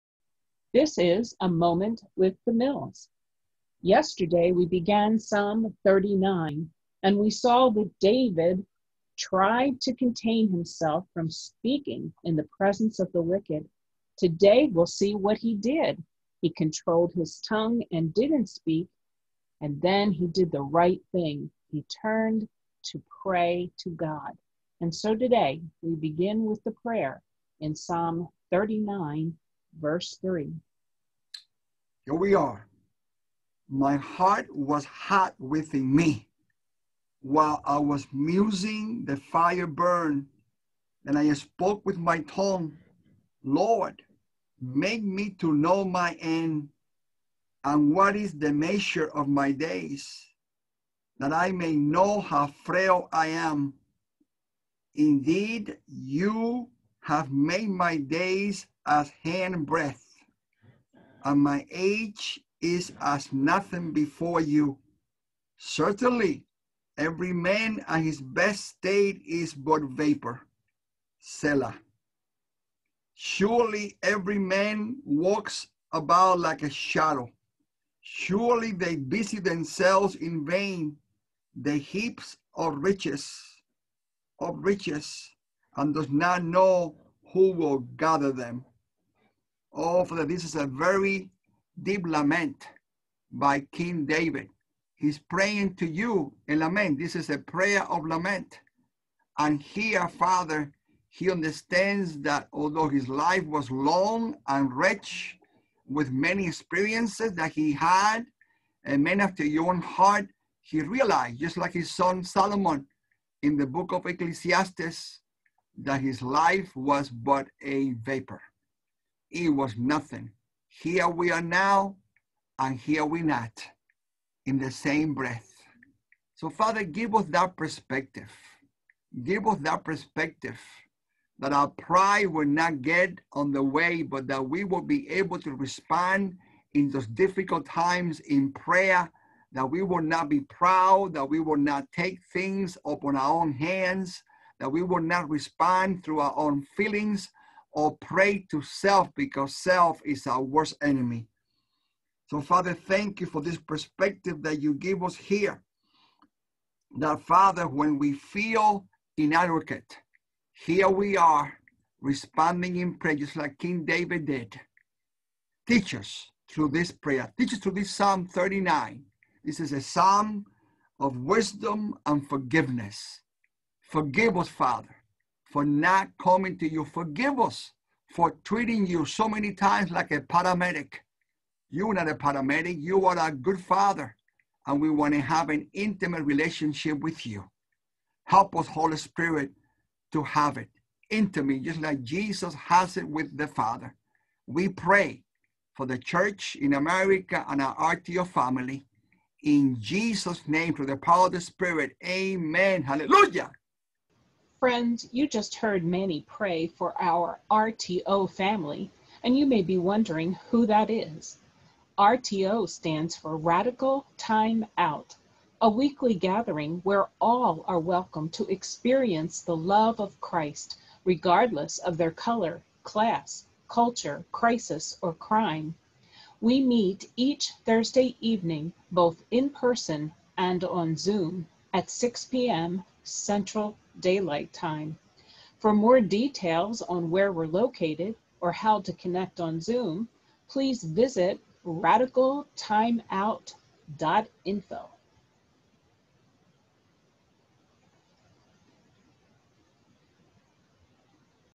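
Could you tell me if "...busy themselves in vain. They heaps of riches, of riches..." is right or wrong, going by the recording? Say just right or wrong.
right.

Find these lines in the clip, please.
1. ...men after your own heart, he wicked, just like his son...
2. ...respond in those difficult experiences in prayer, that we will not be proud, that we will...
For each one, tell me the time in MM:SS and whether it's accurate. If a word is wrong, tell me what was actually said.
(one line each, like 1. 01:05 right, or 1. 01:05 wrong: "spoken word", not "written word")
1. 01:49 wrong: "realized", not "wicked"
2. 02:15 wrong: "times", not "experiences".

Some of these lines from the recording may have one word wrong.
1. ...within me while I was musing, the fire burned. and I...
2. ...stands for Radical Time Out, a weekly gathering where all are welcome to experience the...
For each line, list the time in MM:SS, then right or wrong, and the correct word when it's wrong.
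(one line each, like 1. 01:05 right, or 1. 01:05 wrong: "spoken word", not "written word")
1. 00:35 right
2. 03:32 right.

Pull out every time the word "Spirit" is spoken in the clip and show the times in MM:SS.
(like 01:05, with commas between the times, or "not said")
03:08, 03:21.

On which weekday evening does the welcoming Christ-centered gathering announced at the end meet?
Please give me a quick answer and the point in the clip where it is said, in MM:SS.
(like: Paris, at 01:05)
Thursday, at 03:47.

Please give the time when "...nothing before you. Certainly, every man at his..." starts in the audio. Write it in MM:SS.
01:03.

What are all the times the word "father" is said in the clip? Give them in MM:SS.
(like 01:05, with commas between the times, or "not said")
01:30, 01:40, 02:06, 02:32, 02:37, 02:54, 03:03, 03:13.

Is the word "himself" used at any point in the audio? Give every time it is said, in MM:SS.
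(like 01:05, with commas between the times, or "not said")
00:10.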